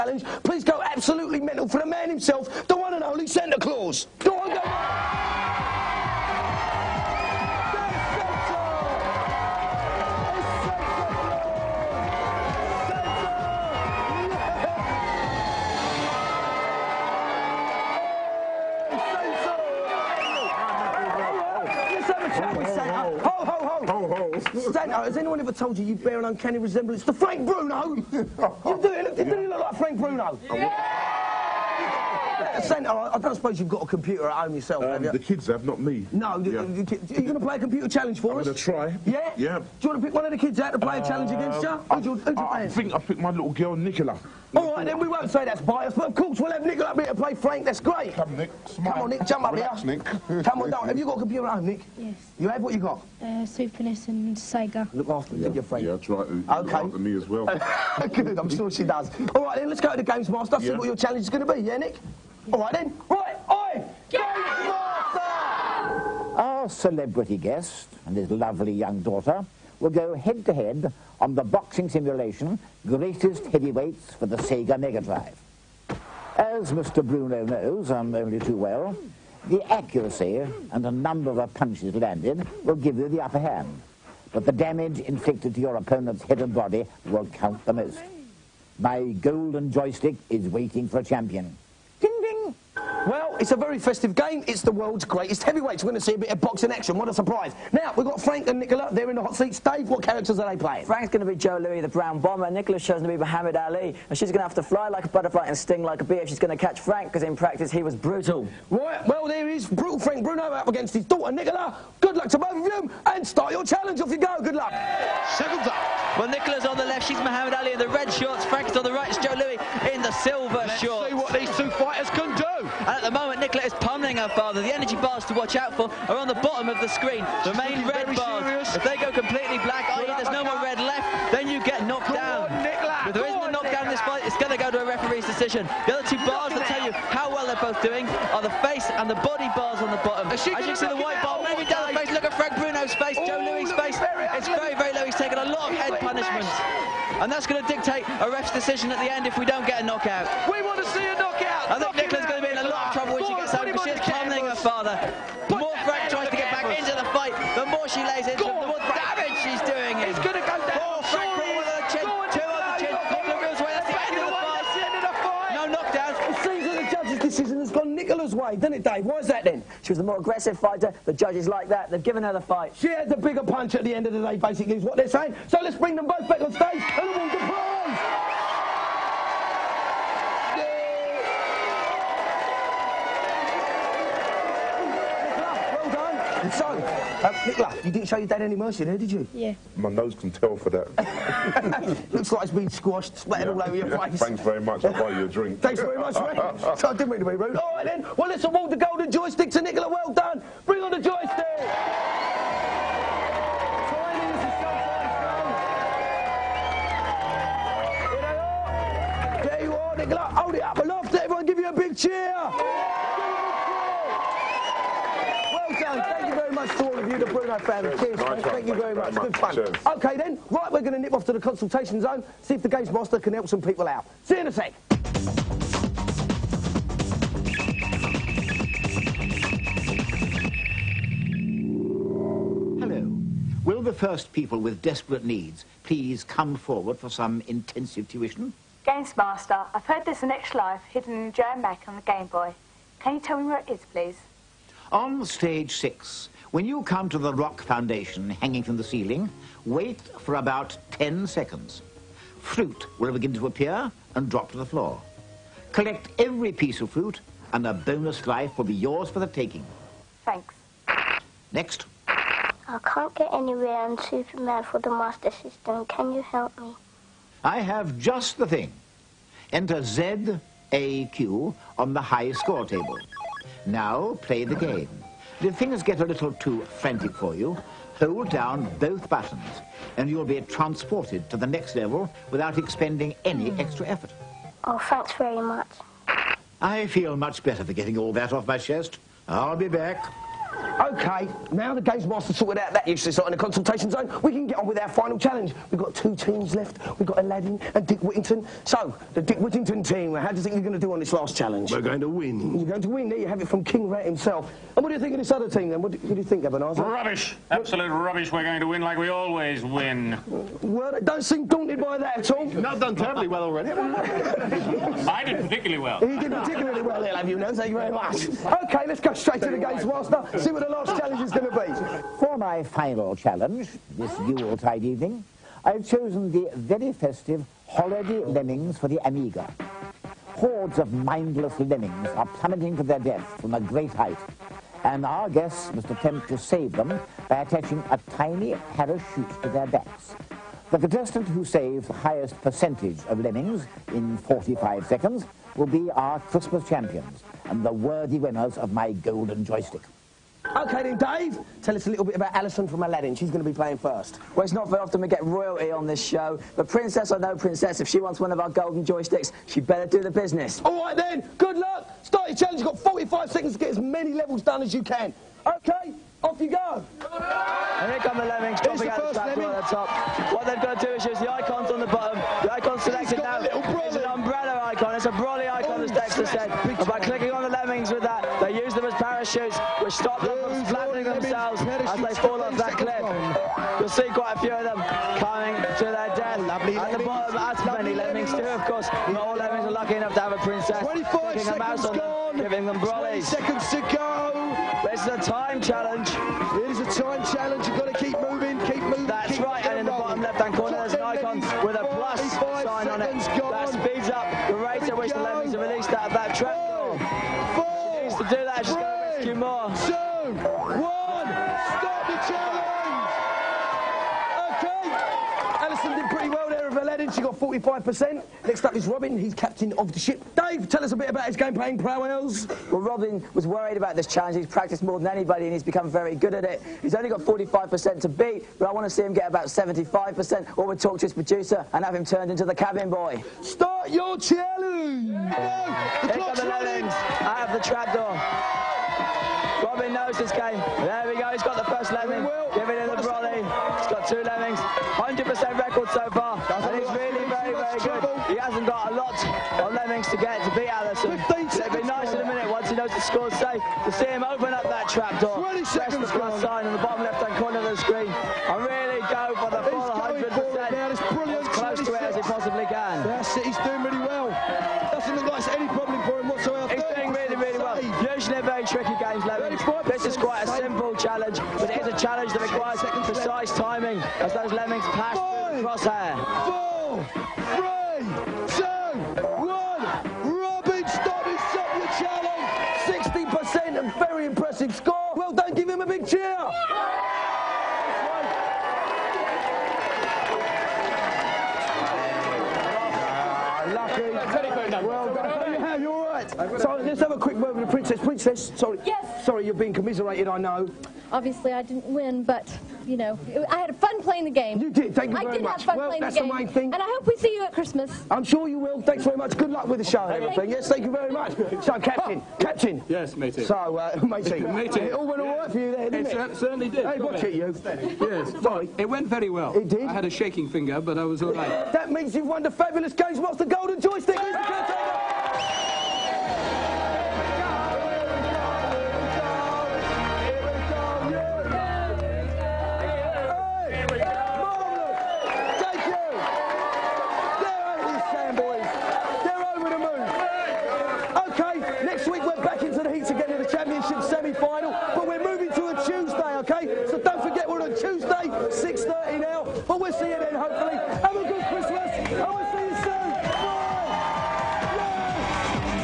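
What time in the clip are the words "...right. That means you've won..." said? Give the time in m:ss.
8:41.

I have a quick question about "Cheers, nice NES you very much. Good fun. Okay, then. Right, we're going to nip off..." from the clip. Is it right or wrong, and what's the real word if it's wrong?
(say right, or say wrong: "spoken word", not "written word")
wrong: "Thank", not "NES".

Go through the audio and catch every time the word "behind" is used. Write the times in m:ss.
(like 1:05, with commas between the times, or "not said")
not said.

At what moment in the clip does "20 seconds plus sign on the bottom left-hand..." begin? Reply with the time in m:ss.
7:35.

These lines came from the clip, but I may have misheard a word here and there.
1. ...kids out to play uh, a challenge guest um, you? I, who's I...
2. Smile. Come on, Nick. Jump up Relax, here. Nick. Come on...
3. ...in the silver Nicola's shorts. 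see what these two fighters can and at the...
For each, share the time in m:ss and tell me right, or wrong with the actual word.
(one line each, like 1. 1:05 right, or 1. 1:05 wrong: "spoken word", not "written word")
1. 0:40 wrong: "against", not "guest"
2. 0:48 right
3. 1:59 wrong: "Let", not "Nicola".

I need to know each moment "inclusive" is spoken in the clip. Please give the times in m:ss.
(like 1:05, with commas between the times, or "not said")
not said.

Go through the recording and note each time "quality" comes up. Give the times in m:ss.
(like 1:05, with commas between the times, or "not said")
not said.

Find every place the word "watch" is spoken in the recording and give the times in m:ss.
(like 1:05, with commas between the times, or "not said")
2:05, 8:36.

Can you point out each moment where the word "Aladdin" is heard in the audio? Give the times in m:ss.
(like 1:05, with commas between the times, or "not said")
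4:57, 5:52.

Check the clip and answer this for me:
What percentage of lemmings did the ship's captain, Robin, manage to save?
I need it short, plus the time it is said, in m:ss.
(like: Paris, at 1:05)
60%, at 8:03.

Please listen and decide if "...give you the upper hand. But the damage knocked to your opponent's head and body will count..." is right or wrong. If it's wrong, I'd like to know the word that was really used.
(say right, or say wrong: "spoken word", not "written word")
wrong: "inflicted", not "knocked".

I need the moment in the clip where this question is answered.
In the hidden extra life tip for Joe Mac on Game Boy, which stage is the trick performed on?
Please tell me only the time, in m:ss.
4:05.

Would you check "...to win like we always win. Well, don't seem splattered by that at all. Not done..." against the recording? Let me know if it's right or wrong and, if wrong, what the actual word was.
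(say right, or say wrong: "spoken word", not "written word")
wrong: "daunted", not "splattered".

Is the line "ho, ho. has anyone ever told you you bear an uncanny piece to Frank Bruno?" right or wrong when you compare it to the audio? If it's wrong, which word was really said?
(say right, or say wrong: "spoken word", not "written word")
wrong: "resemblance", not "piece".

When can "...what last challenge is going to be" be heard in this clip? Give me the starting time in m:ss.
5:20.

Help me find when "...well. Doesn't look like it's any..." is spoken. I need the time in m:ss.
7:44.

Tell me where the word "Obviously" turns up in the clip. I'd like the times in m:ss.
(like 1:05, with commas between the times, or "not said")
8:21.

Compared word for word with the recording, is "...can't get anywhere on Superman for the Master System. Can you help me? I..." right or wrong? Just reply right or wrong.
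right.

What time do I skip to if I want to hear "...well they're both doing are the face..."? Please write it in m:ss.
2:17.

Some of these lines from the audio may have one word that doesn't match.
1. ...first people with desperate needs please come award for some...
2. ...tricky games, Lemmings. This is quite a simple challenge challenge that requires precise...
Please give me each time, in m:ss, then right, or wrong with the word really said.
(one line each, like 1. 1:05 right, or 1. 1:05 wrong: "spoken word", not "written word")
1. 3:54 wrong: "forward", not "award"
2. 7:48 right.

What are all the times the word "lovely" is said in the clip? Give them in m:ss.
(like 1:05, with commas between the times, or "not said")
1:08, 6:26.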